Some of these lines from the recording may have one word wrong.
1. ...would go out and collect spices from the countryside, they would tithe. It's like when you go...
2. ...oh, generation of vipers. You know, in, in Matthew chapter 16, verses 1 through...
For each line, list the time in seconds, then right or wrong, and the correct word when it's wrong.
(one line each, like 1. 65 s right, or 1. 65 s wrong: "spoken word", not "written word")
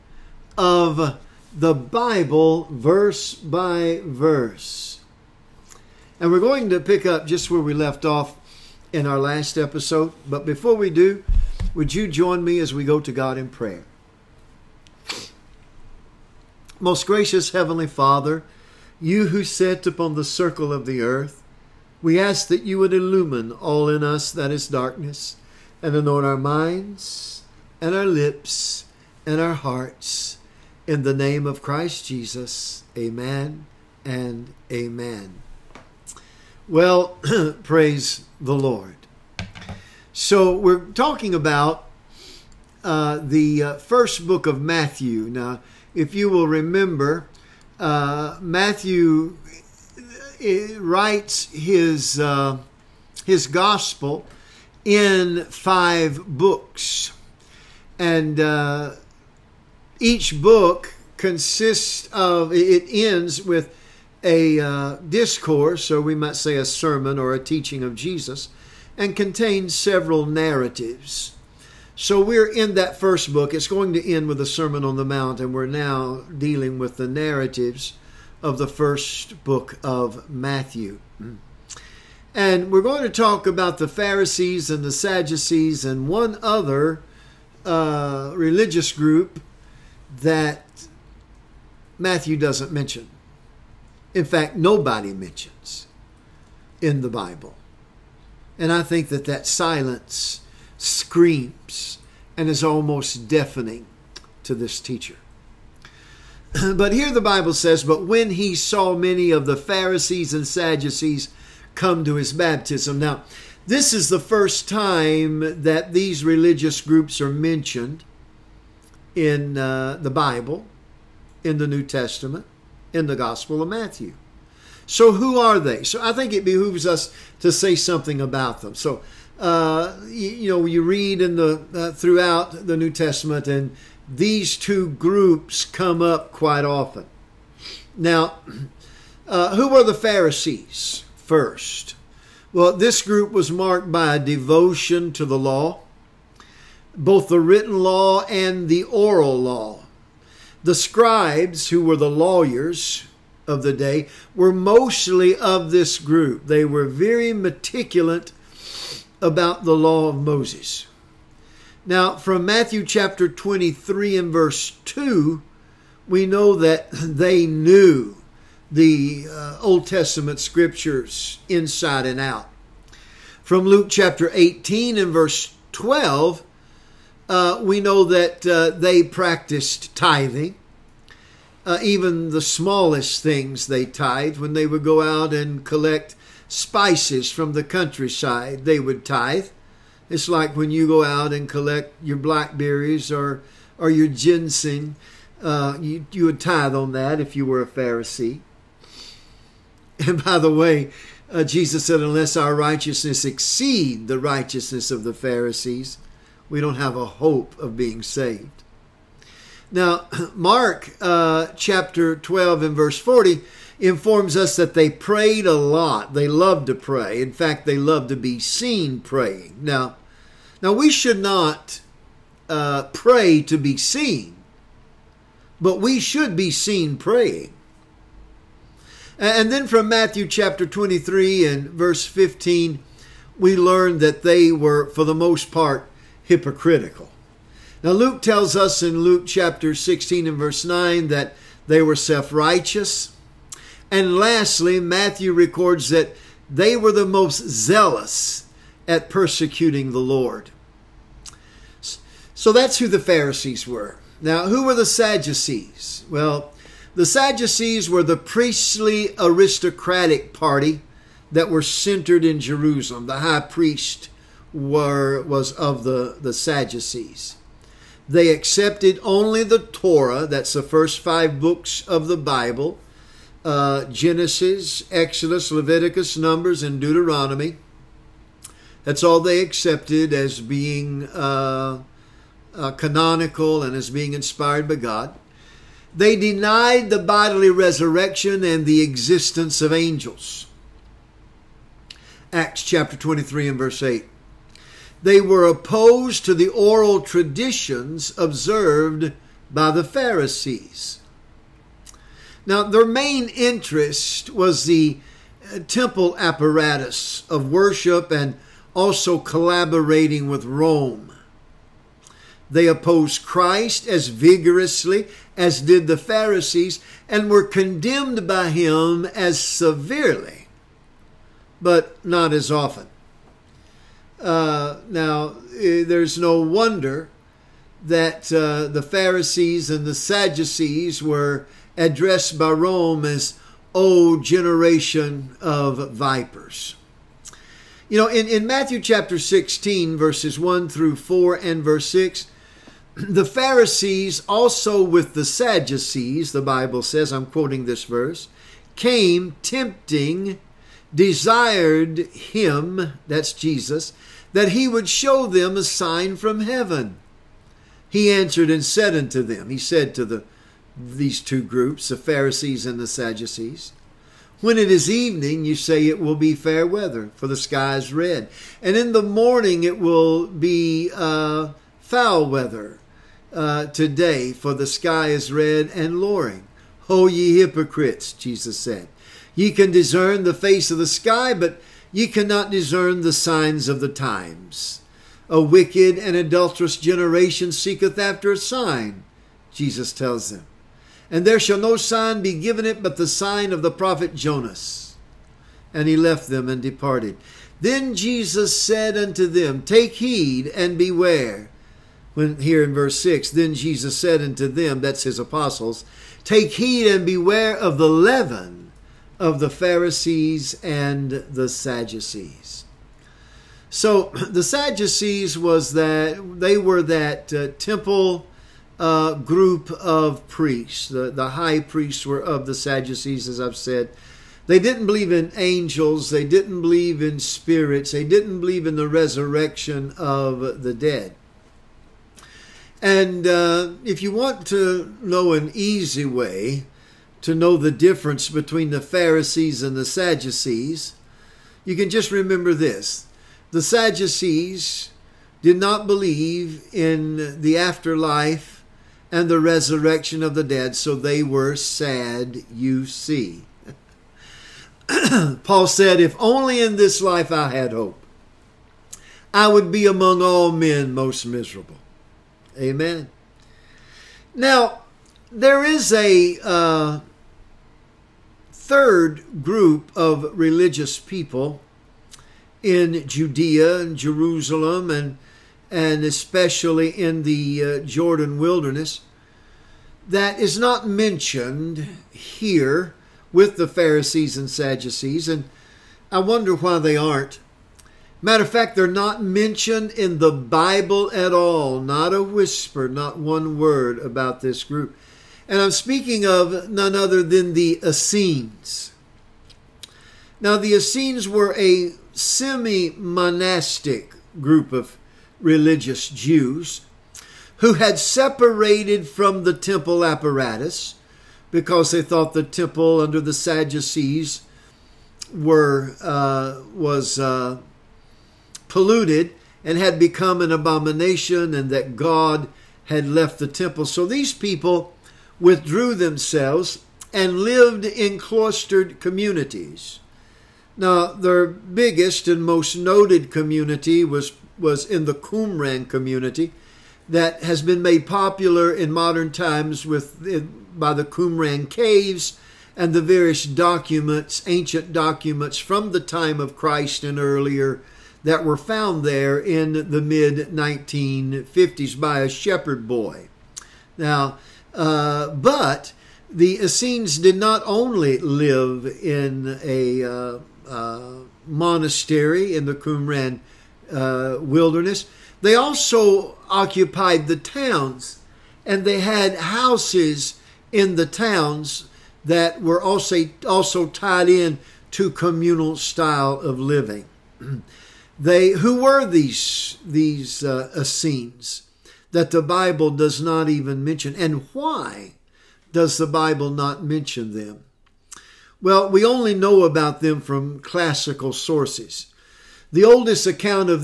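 1. 184 s right
2. 334 s right.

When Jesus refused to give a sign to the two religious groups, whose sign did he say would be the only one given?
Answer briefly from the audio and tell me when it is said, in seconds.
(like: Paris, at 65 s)
Jonas, at 393 s.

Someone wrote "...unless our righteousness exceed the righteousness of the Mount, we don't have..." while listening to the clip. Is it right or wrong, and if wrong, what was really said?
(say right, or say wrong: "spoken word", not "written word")
wrong: "Pharisees", not "Mount".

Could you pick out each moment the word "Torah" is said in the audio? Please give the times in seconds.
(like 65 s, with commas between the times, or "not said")
269 s.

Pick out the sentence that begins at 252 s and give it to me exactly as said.
So that's who the Pharisees were.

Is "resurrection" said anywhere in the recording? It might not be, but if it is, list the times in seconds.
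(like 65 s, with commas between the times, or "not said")
287 s, 428 s, 449 s.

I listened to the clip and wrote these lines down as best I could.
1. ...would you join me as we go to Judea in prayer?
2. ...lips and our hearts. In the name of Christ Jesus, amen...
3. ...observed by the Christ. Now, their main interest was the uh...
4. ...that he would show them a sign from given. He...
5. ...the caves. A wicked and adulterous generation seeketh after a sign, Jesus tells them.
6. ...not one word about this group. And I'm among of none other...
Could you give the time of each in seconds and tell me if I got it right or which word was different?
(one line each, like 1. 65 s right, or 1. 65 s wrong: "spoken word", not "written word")
1. 11 s wrong: "God", not "Judea"
2. 28 s right
3. 298 s wrong: "Pharisees", not "Christ"
4. 354 s wrong: "heaven", not "given"
5. 383 s wrong: "times", not "caves"
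6. 492 s wrong: "speaking", not "among".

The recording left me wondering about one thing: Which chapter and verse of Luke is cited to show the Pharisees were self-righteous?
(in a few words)
Luke 16:9.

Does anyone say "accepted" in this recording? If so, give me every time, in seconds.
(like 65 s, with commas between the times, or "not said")
268 s, 279 s.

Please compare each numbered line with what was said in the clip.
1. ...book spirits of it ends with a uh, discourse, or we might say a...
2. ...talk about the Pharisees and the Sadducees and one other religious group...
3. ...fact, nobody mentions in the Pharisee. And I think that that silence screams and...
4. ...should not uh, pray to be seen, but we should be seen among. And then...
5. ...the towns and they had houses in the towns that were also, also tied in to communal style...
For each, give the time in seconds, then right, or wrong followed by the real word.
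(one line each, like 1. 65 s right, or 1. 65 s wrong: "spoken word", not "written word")
1. 60 s wrong: "consists", not "spirits"
2. 83 s right
3. 94 s wrong: "Bible", not "Pharisee"
4. 220 s wrong: "praying", not "among"
5. 567 s right.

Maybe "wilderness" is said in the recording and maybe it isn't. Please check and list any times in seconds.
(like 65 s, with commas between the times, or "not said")
478 s, 564 s.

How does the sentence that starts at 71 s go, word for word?
So we're in that first book.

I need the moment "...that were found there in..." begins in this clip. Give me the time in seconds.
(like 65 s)
548 s.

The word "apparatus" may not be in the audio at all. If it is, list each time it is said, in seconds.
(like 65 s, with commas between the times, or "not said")
306 s, 510 s.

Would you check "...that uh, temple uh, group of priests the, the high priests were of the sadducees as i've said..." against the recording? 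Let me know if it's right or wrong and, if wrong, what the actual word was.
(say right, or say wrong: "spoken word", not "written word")
right.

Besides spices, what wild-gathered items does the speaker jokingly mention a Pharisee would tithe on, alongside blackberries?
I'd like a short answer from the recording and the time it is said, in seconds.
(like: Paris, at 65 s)
ginseng, at 194 s.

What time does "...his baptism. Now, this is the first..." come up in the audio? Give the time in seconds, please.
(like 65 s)
112 s.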